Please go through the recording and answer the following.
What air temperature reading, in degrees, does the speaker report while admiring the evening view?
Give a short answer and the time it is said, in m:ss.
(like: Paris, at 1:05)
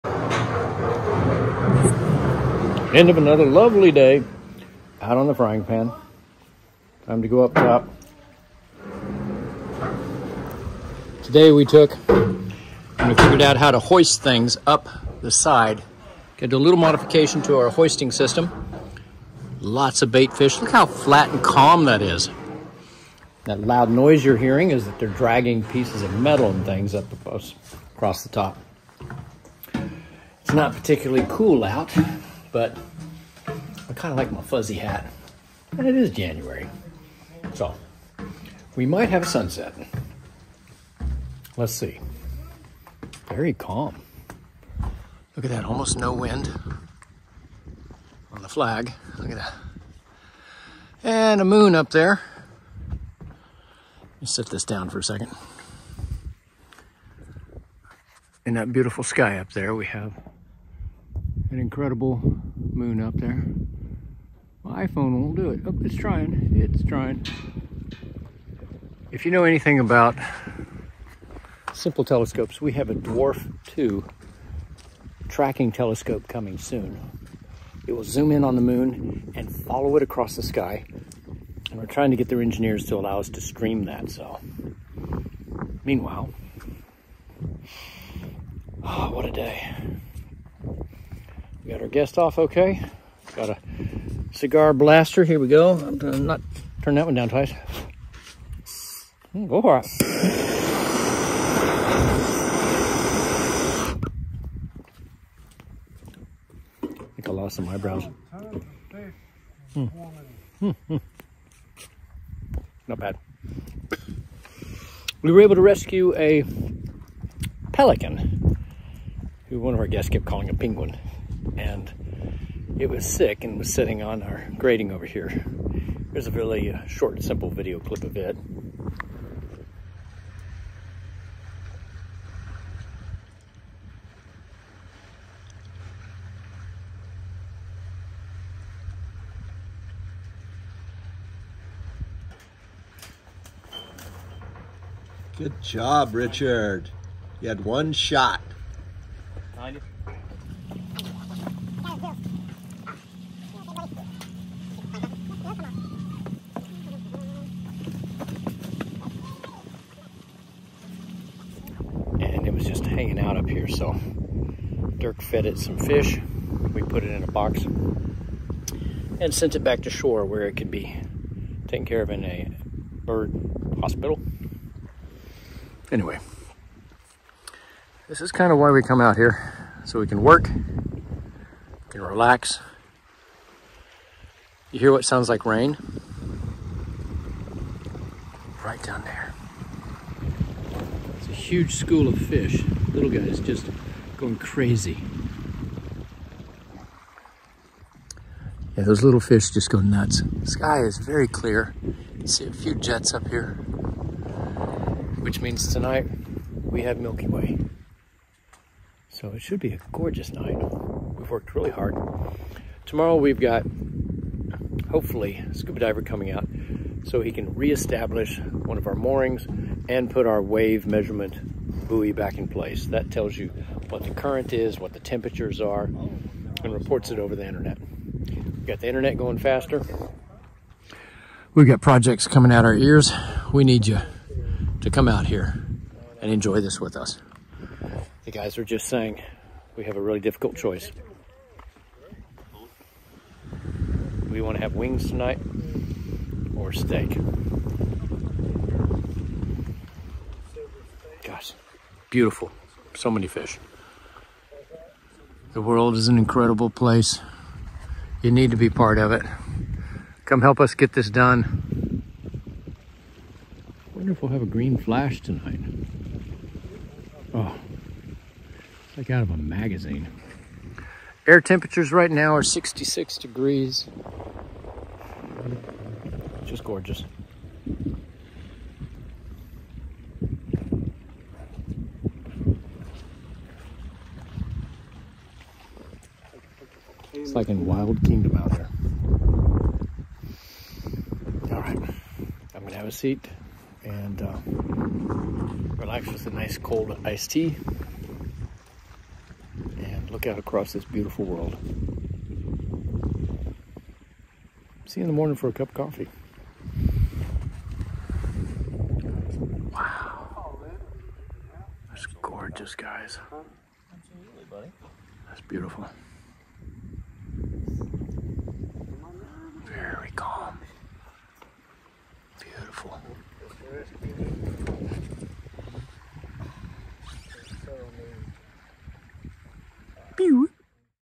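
66, at 4:32.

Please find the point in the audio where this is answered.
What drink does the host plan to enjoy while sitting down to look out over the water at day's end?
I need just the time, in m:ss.
4:57.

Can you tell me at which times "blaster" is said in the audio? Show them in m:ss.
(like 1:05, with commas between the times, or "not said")
1:34.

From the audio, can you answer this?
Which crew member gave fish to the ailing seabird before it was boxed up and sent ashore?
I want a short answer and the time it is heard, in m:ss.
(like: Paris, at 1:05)
Dirk, at 2:44.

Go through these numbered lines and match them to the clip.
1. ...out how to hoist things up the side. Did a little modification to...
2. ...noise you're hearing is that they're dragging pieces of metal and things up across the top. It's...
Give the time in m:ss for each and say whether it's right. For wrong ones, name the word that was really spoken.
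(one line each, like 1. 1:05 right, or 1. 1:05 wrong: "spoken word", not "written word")
1. 0:13 right
2. 0:23 right.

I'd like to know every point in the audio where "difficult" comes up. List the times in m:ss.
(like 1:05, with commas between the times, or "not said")
4:00.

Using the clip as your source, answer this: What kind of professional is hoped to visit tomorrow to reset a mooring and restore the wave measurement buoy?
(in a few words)
scuba diver.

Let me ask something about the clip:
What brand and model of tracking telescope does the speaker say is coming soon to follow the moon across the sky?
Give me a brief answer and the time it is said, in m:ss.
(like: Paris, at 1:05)
Dwarf 2, at 1:12.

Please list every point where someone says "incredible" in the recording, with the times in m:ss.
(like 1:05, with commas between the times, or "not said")
1:01, 4:16.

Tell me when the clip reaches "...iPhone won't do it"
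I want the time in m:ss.
1:04.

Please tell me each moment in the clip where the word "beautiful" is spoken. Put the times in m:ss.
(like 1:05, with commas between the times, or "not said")
0:58, 4:12, 5:00, 5:15, 5:24.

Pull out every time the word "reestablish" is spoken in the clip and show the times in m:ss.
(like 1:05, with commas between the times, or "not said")
3:37.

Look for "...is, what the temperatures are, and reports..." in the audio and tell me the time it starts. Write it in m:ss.
3:44.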